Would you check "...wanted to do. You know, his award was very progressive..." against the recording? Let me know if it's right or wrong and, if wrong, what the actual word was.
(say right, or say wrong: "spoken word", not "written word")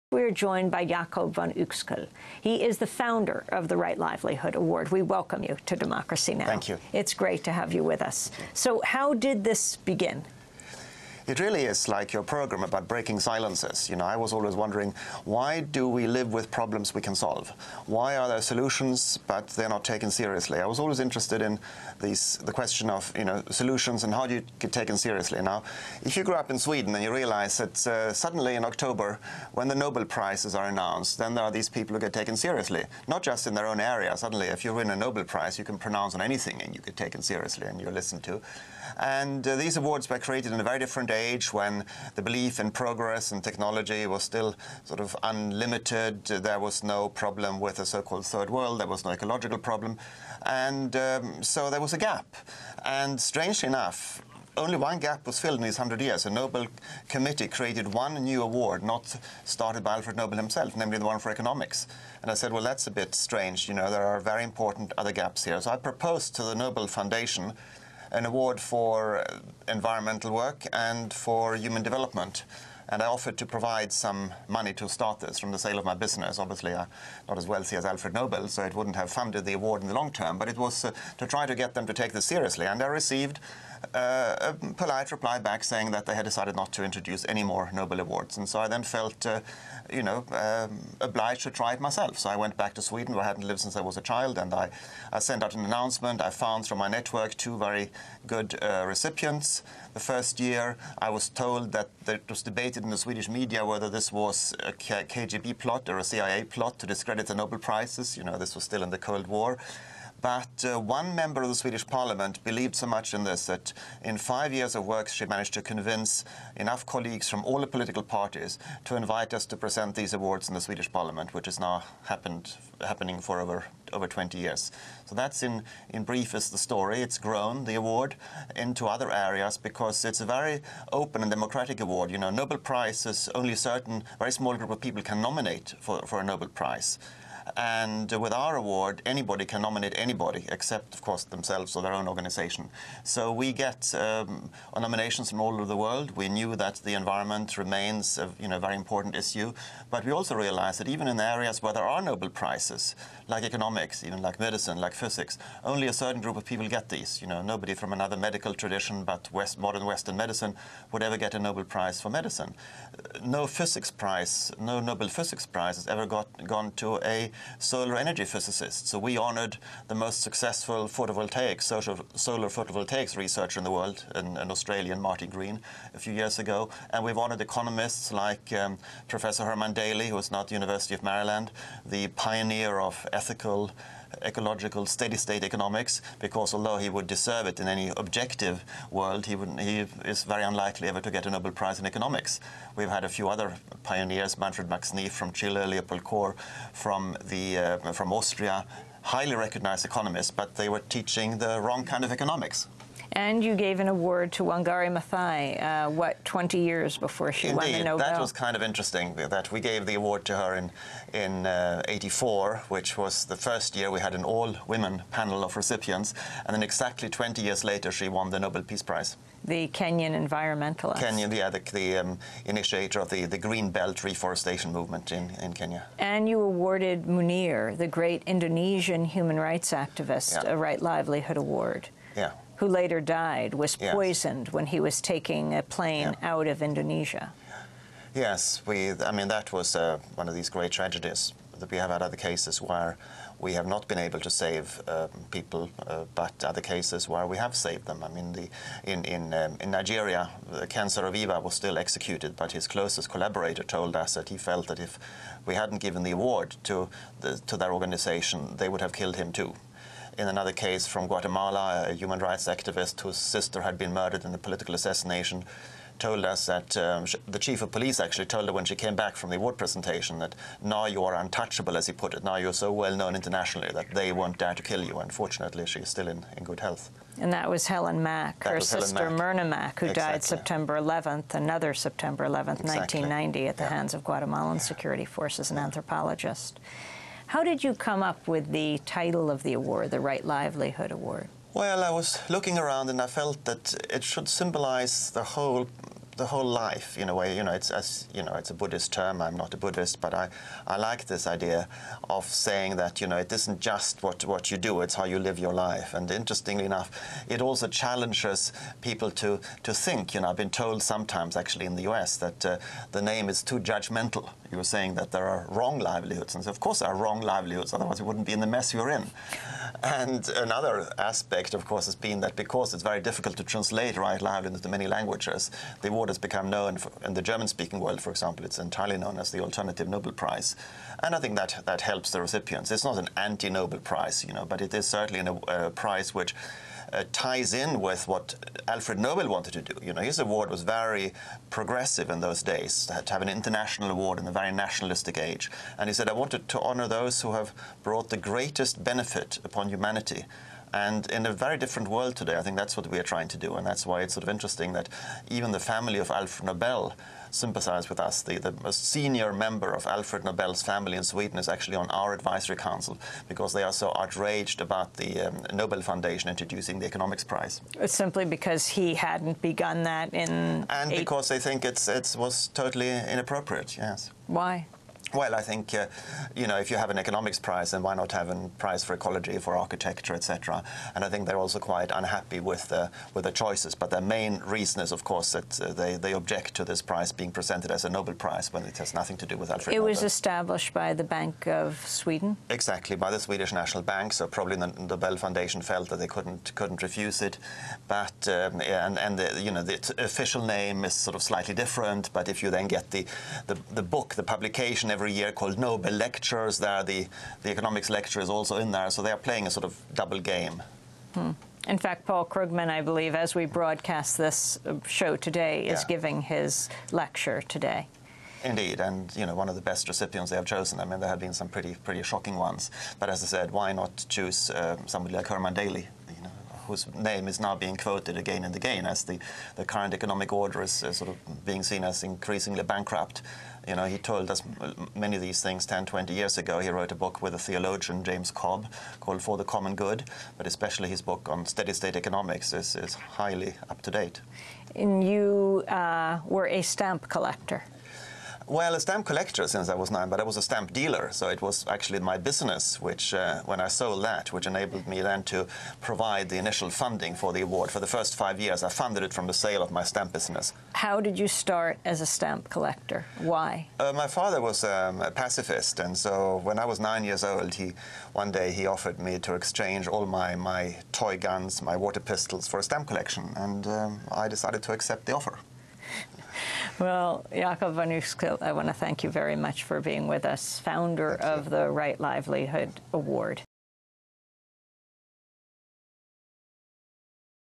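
right.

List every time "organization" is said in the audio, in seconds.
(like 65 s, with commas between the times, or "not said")
142 s, 257 s.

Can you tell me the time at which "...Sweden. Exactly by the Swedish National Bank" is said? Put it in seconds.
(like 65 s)
391 s.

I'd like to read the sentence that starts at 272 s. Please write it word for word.
Now you're so well known internationally that they won't dare to kill you.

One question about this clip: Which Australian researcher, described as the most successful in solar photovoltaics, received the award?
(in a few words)
Marty Green.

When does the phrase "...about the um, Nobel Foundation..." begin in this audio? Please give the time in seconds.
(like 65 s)
364 s.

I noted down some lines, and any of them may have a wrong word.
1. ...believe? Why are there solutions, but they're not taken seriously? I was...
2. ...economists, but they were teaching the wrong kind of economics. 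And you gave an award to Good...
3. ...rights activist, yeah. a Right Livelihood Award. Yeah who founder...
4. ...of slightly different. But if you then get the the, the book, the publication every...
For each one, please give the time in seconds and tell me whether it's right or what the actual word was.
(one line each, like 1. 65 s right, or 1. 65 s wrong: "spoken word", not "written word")
1. 17 s wrong: "solve", not "believe"
2. 199 s wrong: "Wangari", not "Good"
3. 229 s wrong: "later", not "founder"
4. 401 s right.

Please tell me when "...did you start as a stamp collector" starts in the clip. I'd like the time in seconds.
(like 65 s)
460 s.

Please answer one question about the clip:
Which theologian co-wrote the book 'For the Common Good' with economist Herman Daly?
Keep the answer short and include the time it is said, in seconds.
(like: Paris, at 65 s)
James Cobb, at 438 s.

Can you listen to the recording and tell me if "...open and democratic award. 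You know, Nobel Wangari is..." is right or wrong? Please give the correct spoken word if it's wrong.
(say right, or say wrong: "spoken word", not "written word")
wrong: "Prize", not "Wangari".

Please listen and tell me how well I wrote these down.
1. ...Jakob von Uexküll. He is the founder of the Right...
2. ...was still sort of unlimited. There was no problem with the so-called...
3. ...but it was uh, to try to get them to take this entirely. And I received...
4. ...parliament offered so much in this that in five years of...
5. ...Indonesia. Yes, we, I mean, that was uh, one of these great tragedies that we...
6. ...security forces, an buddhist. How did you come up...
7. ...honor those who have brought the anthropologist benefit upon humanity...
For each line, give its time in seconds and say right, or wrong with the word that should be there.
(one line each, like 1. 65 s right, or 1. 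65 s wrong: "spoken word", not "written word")
1. 0 s right
2. 44 s right
3. 80 s wrong: "seriously", not "entirely"
4. 111 s wrong: "believed", not "offered"
5. 236 s right
6. 284 s wrong: "anthropologist", not "buddhist"
7. 346 s wrong: "greatest", not "anthropologist".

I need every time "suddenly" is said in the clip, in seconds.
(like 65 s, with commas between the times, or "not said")
28 s, 34 s.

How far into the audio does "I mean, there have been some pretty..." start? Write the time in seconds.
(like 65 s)
420 s.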